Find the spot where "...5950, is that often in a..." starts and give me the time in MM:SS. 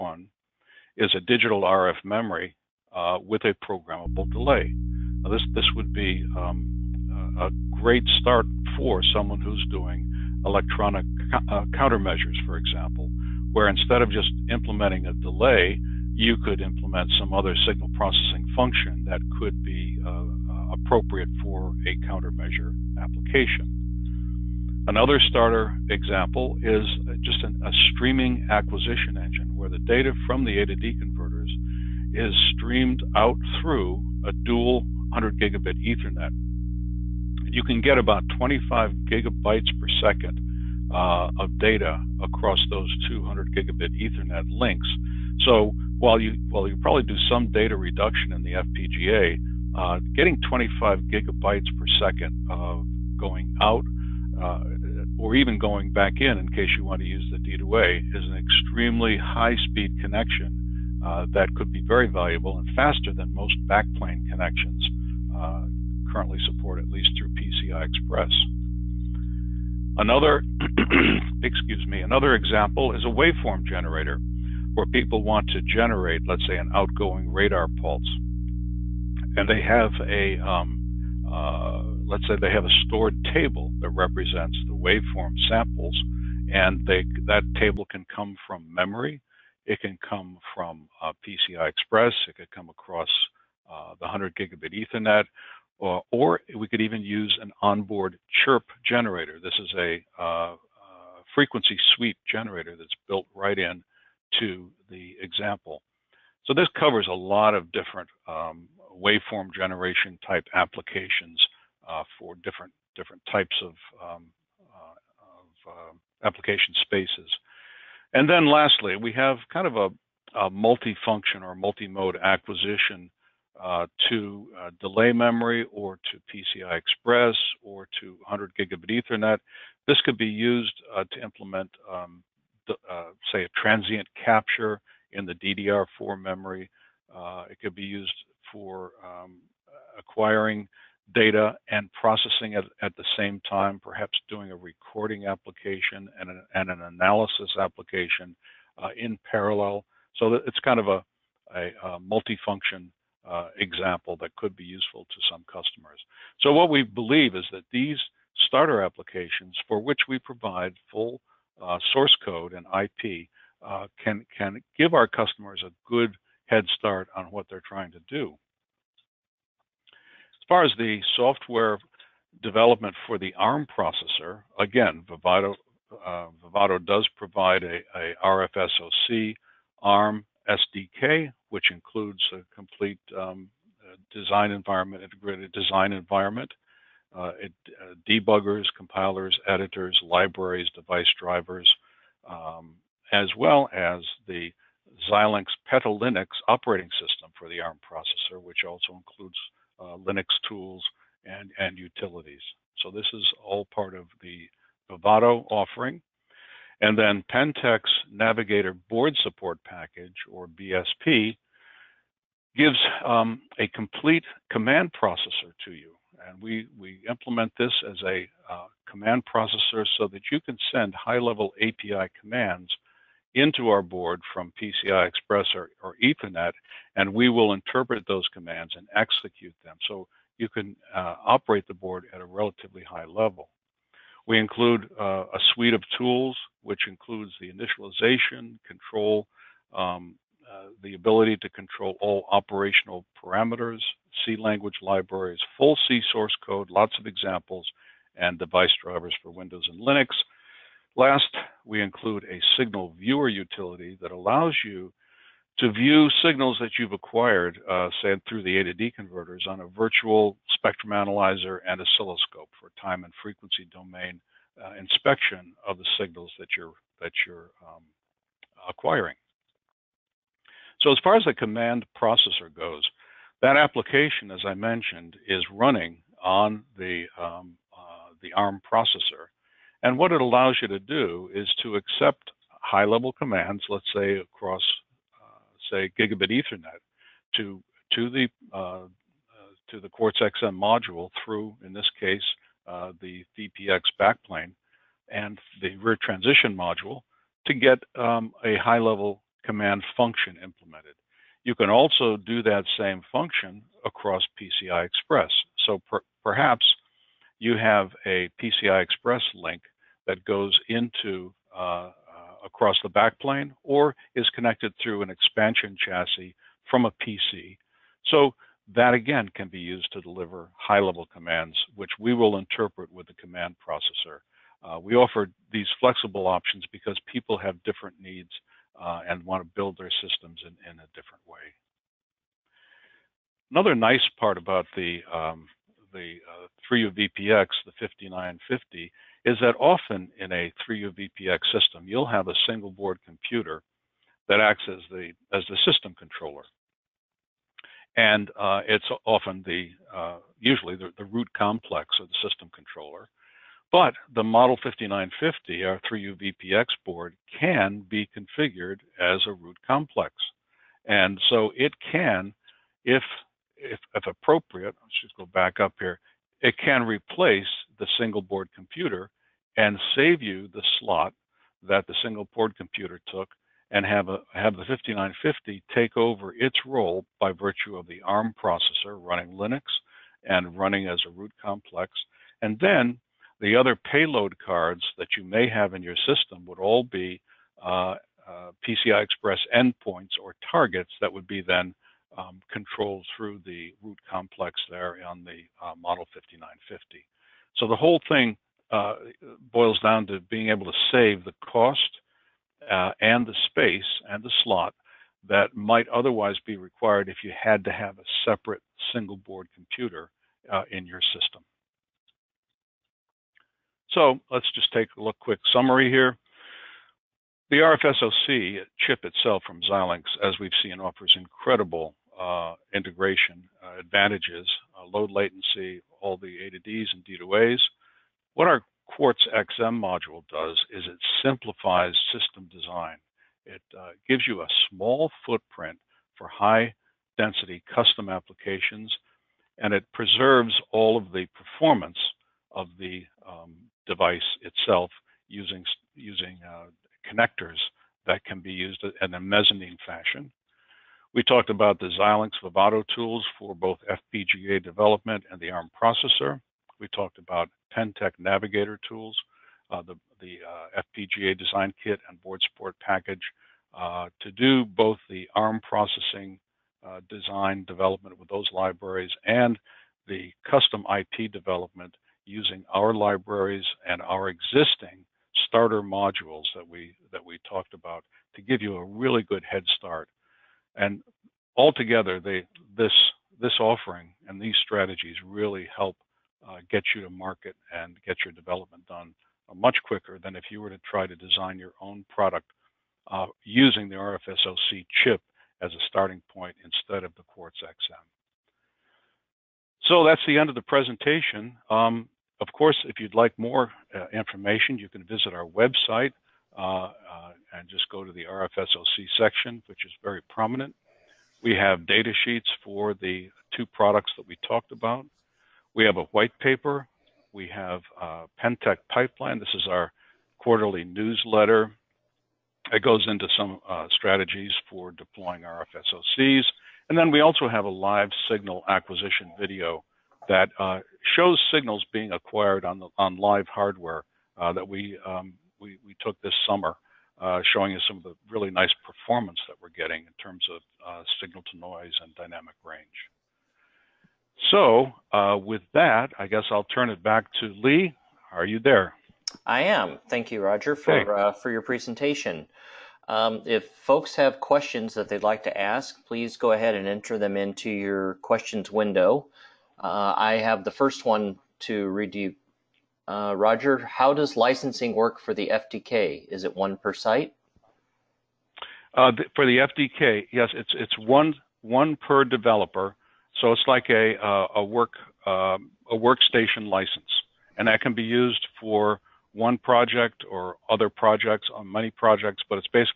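05:37.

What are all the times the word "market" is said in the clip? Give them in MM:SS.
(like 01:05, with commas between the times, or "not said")
08:07.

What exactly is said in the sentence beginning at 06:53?
So let's just take a look quick summary here.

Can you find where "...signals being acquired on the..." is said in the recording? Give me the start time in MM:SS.
08:51.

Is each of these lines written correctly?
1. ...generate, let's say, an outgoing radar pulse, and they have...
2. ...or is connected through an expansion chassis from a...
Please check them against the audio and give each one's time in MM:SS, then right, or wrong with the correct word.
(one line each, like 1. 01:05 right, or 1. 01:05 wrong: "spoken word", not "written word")
1. 01:15 right
2. 05:13 right.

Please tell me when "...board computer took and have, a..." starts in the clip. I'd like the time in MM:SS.
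06:12.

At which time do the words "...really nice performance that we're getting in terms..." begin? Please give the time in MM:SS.
08:58.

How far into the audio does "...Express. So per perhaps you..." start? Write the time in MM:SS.
05:04.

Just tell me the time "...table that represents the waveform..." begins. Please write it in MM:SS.
01:23.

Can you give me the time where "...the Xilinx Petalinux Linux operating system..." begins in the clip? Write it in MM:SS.
03:14.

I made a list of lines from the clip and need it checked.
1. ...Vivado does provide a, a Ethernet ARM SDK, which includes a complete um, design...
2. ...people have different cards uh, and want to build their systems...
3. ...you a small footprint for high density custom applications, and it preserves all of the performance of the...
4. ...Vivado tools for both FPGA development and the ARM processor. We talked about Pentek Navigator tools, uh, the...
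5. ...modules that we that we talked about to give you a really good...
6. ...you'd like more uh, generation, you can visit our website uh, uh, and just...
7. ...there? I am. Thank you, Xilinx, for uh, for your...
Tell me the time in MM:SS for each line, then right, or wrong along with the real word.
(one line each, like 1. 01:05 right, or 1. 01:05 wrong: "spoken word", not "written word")
1. 02:56 wrong: "RFSoC", not "Ethernet"
2. 05:27 wrong: "needs", not "cards"
3. 07:14 right
4. 07:32 right
5. 07:55 right
6. 08:22 wrong: "information", not "generation"
7. 09:08 wrong: "Rodger", not "Xilinx".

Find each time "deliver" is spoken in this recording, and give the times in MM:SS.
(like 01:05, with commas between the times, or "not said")
05:20.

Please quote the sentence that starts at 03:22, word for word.
So this is all part of the Vivado offering.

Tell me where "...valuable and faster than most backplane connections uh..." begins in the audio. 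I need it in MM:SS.
01:02.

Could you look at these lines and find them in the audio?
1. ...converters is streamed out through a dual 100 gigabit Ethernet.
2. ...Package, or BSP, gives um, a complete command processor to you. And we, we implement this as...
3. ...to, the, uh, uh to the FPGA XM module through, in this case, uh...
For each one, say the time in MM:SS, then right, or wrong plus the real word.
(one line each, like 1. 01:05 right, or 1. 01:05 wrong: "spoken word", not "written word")
1. 00:30 right
2. 03:29 right
3. 04:47 wrong: "Quartz", not "FPGA".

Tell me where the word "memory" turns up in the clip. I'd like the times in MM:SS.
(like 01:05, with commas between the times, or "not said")
00:02, 01:28, 02:05, 02:16.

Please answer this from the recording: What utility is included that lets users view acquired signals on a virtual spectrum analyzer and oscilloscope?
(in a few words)
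signal viewer.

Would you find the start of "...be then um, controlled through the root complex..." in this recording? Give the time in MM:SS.
06:31.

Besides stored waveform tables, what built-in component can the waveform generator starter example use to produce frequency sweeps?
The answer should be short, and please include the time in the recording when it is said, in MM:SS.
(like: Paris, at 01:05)
chirp generator, at 01:38.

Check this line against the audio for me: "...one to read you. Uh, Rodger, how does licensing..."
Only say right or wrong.
right.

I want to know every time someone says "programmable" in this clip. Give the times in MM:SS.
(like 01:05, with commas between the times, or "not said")
00:03.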